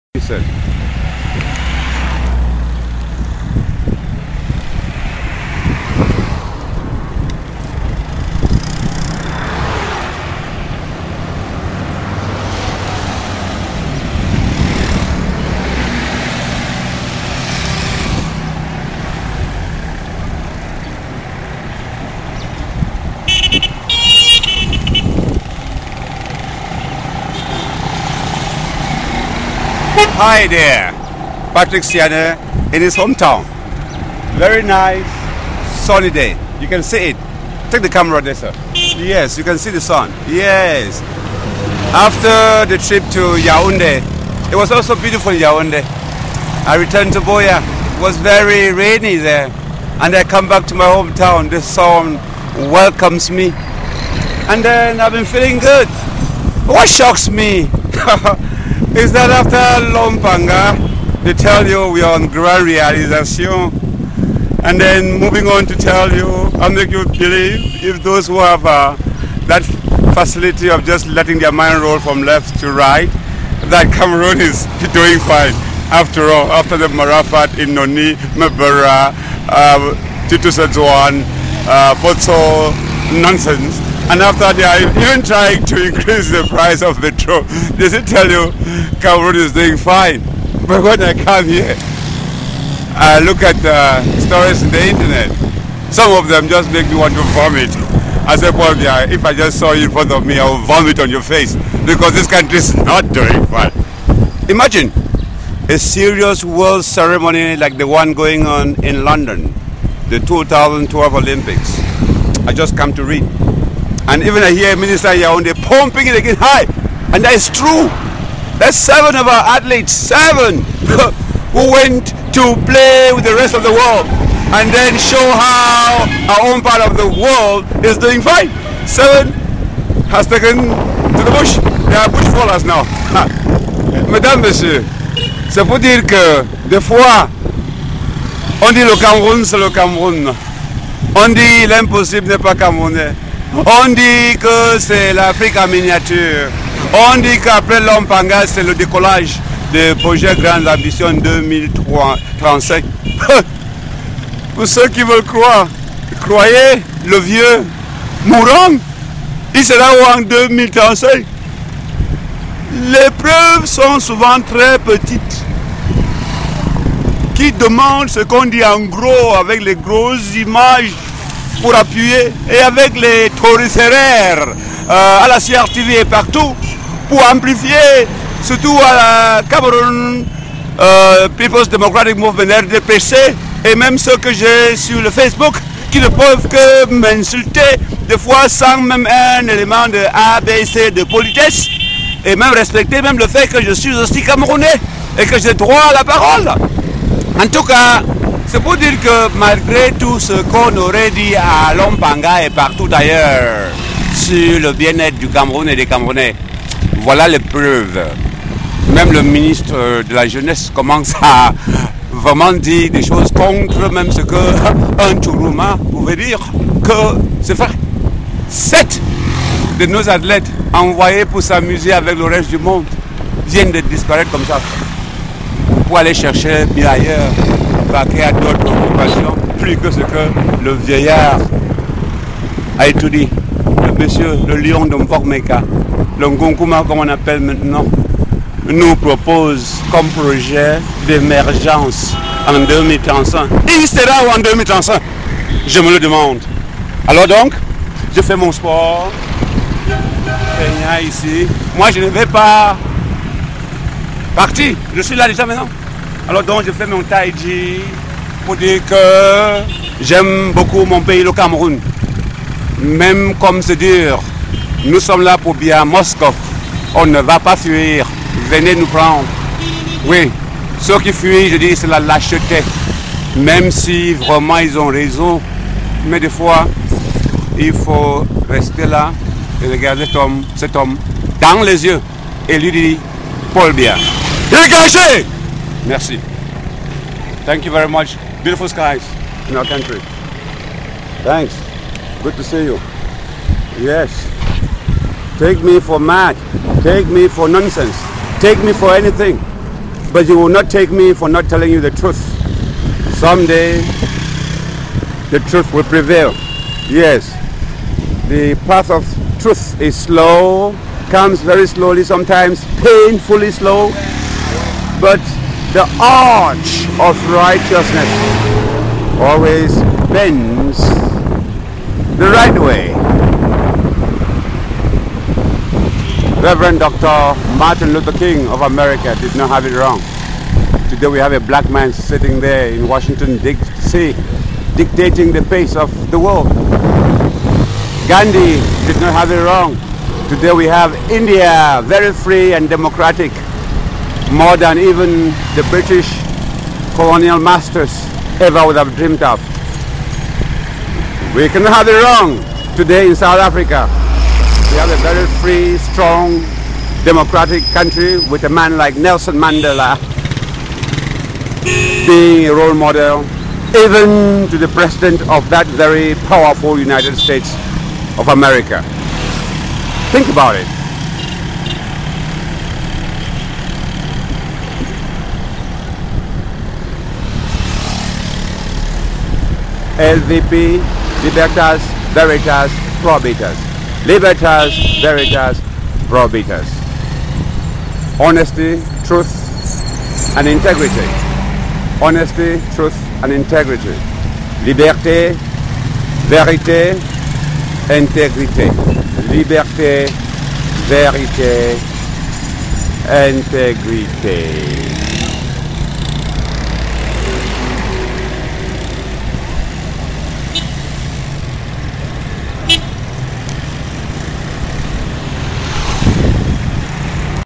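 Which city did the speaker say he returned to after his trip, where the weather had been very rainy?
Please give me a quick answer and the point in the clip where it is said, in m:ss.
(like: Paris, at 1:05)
Buea, at 0:47.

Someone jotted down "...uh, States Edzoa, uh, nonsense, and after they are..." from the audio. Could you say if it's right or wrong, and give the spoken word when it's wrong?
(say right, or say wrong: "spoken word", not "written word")
wrong: "Titus", not "States".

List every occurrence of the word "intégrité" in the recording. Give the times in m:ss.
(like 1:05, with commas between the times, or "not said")
6:37, 6:43.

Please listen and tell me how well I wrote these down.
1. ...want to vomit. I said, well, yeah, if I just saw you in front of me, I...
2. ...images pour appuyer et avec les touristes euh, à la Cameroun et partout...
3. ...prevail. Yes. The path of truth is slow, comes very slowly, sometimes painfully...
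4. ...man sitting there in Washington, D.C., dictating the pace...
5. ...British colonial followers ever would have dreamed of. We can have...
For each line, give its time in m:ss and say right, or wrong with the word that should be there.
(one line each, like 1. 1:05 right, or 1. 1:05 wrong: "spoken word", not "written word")
1. 1:36 right
2. 2:50 wrong: "CRTV", not "Cameroun"
3. 5:05 right
4. 5:31 right
5. 5:45 wrong: "masters", not "followers".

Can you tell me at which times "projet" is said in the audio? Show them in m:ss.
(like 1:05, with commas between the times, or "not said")
2:30, 4:00.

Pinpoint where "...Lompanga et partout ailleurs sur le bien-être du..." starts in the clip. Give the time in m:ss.
3:21.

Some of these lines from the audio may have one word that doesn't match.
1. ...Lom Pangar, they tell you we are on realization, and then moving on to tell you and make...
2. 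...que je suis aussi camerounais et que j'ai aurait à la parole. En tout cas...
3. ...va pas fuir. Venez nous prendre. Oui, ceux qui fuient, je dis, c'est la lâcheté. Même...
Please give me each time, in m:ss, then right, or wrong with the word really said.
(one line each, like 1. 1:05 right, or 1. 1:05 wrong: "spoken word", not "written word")
1. 0:59 right
2. 3:13 wrong: "droit", not "aurait"
3. 4:27 right.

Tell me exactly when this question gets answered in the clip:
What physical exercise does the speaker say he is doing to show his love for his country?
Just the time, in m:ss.
4:17.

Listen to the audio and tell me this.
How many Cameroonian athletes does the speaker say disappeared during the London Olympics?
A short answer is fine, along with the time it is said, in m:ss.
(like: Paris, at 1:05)
7, at 2:08.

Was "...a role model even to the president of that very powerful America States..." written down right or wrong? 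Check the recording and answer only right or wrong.
wrong.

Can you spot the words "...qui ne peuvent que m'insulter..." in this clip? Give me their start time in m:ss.
3:05.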